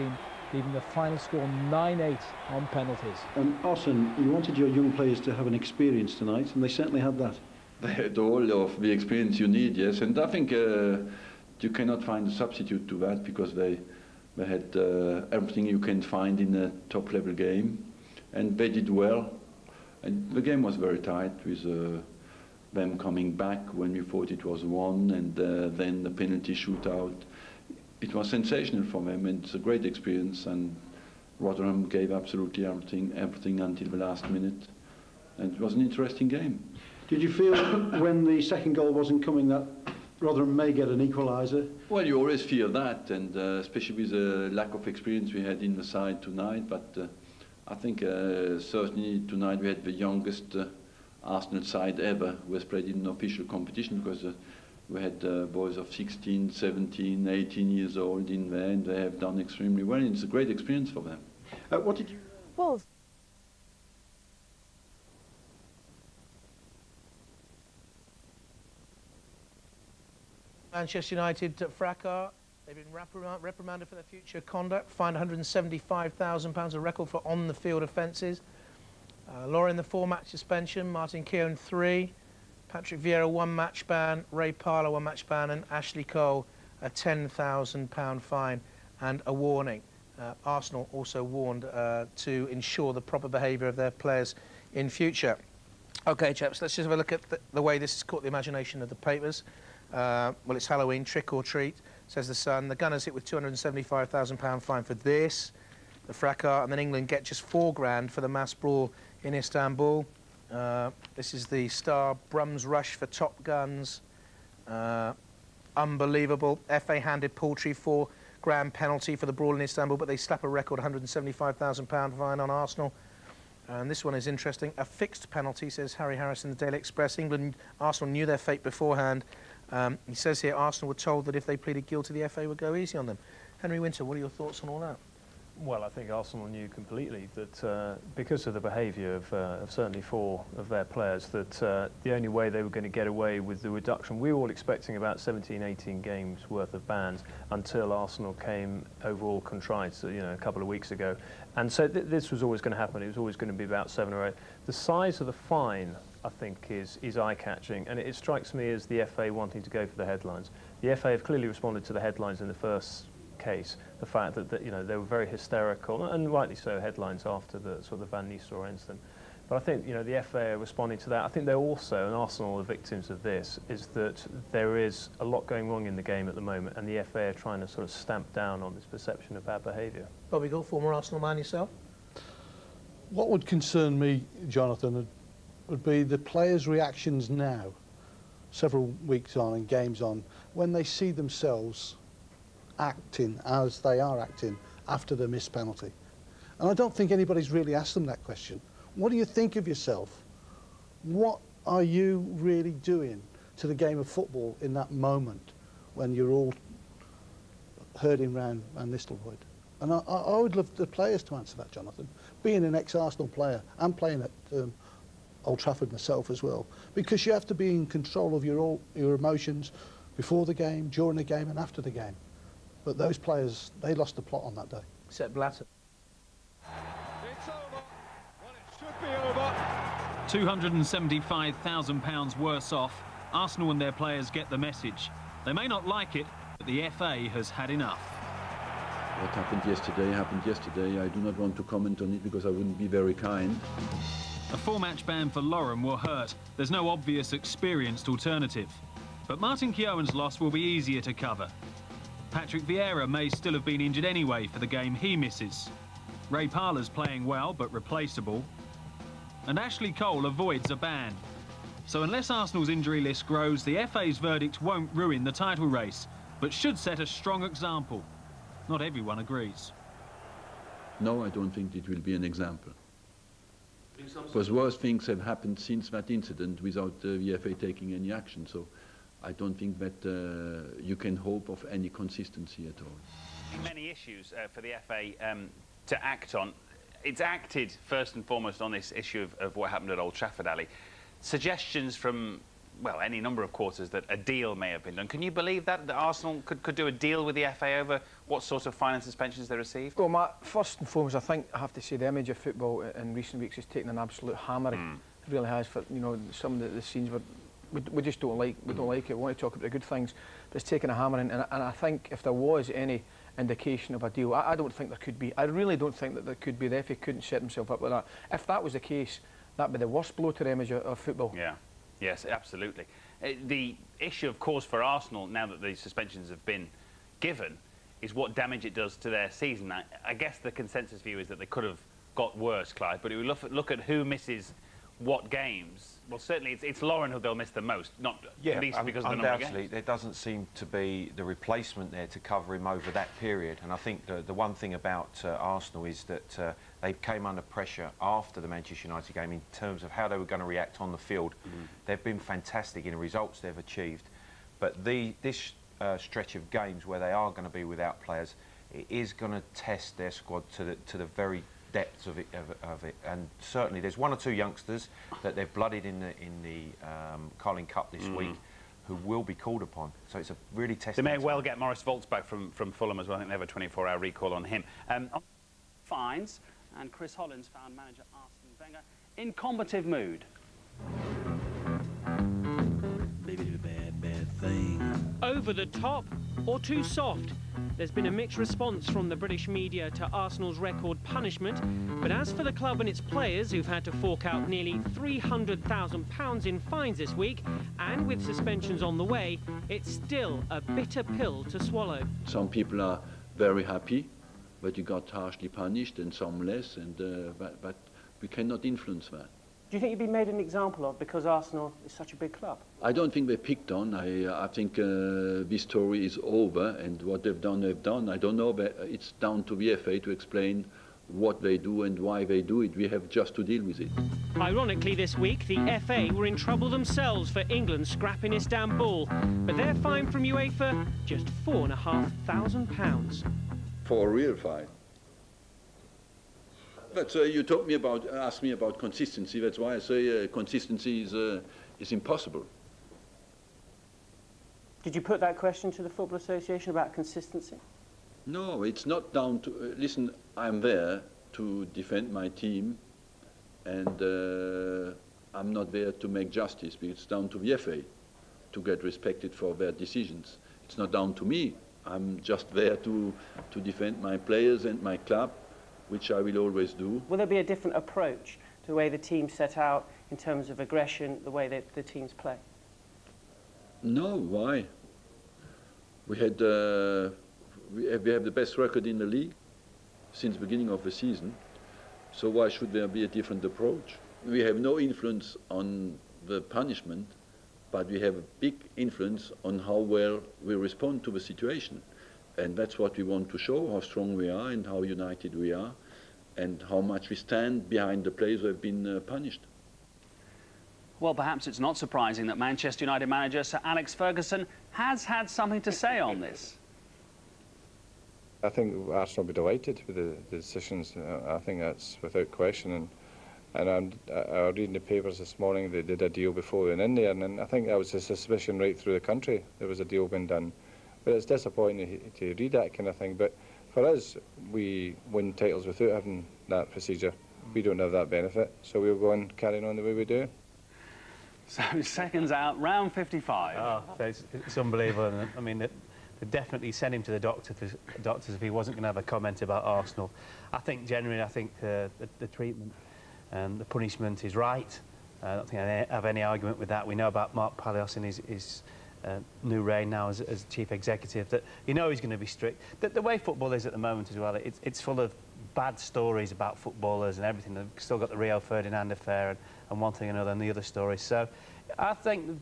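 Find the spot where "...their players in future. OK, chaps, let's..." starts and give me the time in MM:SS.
01:33.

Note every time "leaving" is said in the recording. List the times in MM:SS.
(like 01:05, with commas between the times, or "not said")
00:00.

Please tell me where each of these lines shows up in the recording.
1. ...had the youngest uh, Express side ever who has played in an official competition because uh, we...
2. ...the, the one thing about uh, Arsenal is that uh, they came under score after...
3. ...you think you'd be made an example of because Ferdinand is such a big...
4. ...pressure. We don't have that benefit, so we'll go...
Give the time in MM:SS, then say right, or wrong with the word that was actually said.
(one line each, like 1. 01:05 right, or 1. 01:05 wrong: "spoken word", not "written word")
1. 00:49 wrong: "Arsenal", not "Express"
2. 05:44 wrong: "pressure", not "score"
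3. 06:49 wrong: "Arsenal", not "Ferdinand"
4. 08:46 wrong: "procedure", not "pressure".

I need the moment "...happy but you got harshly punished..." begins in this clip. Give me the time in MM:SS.
06:43.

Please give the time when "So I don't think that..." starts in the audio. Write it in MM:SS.
04:38.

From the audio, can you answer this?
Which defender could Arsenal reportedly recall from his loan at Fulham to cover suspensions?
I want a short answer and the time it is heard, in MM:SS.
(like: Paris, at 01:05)
Moritz Volz, at 06:11.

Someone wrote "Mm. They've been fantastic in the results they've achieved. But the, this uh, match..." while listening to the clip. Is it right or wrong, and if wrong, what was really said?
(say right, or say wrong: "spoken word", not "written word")
wrong: "stretch", not "match".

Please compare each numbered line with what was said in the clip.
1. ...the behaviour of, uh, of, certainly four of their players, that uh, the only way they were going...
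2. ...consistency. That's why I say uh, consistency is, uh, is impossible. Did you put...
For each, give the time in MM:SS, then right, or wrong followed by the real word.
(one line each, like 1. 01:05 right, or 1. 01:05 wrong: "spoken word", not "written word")
1. 02:18 right
2. 07:18 right.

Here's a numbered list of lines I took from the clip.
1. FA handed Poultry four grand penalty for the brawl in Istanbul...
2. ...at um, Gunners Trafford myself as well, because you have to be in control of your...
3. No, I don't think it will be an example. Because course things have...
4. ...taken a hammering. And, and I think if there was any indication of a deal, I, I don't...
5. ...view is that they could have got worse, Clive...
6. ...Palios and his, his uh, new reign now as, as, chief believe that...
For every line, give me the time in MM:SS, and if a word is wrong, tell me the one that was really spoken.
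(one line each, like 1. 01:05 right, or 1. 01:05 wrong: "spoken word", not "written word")
1. 01:56 right
2. 03:34 wrong: "Old", not "Gunners"
3. 04:31 wrong: "worse", not "course"
4. 05:10 right
5. 05:31 right
6. 09:07 wrong: "executive", not "believe".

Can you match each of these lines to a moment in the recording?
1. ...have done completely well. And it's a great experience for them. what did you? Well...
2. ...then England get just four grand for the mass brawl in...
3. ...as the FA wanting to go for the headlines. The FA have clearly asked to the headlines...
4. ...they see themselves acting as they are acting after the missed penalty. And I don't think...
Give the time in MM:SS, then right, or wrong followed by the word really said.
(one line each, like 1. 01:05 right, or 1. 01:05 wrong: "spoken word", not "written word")
1. 00:59 wrong: "extremely", not "completely"
2. 01:46 right
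3. 02:38 wrong: "responded", not "asked"
4. 03:10 right.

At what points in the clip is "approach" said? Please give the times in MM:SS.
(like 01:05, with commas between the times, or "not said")
07:47, 08:03.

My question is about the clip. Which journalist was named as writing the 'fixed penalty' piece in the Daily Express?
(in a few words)
Harry Harrison.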